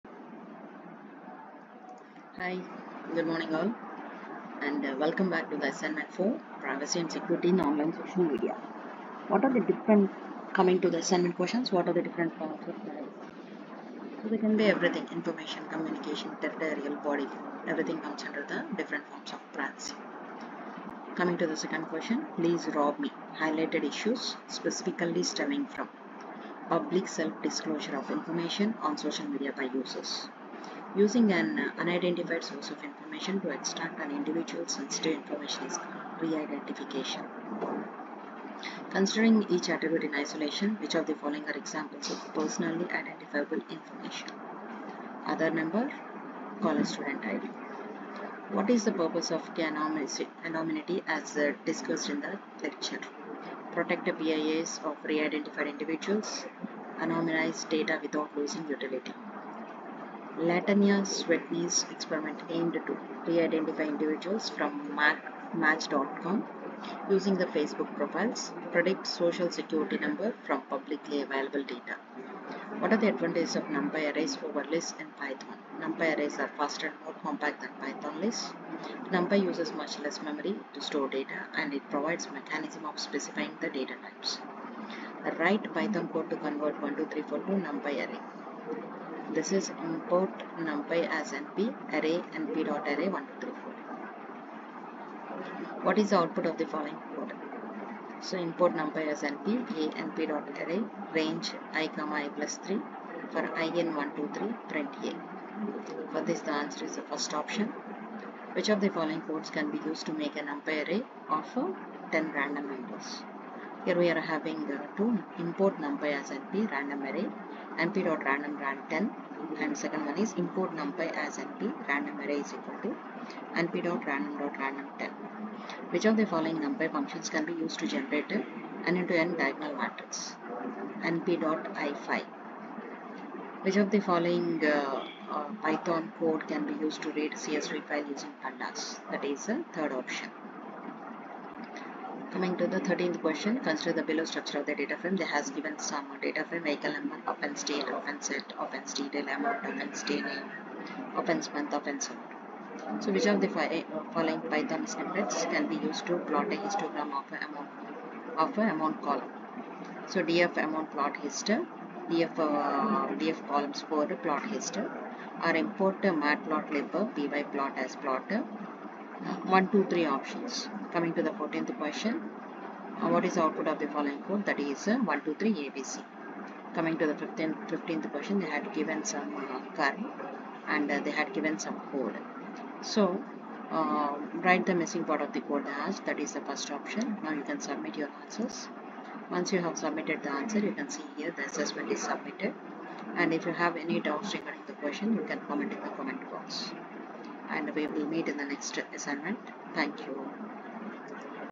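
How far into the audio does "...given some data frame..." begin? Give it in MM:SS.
02:25.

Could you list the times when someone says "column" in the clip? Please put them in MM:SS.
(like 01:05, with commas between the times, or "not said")
02:39, 02:43.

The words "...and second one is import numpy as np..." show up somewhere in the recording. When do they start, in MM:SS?
01:59.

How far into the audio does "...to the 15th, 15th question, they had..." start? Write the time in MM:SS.
02:56.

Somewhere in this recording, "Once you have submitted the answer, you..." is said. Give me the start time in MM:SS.
03:09.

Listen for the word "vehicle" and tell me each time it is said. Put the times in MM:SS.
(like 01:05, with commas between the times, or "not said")
02:26.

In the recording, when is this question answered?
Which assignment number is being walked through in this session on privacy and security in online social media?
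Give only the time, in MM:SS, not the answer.
00:05.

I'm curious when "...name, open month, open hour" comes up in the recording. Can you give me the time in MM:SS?
02:30.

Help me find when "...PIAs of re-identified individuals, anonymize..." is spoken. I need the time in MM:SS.
00:54.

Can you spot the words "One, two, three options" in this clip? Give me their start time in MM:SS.
02:49.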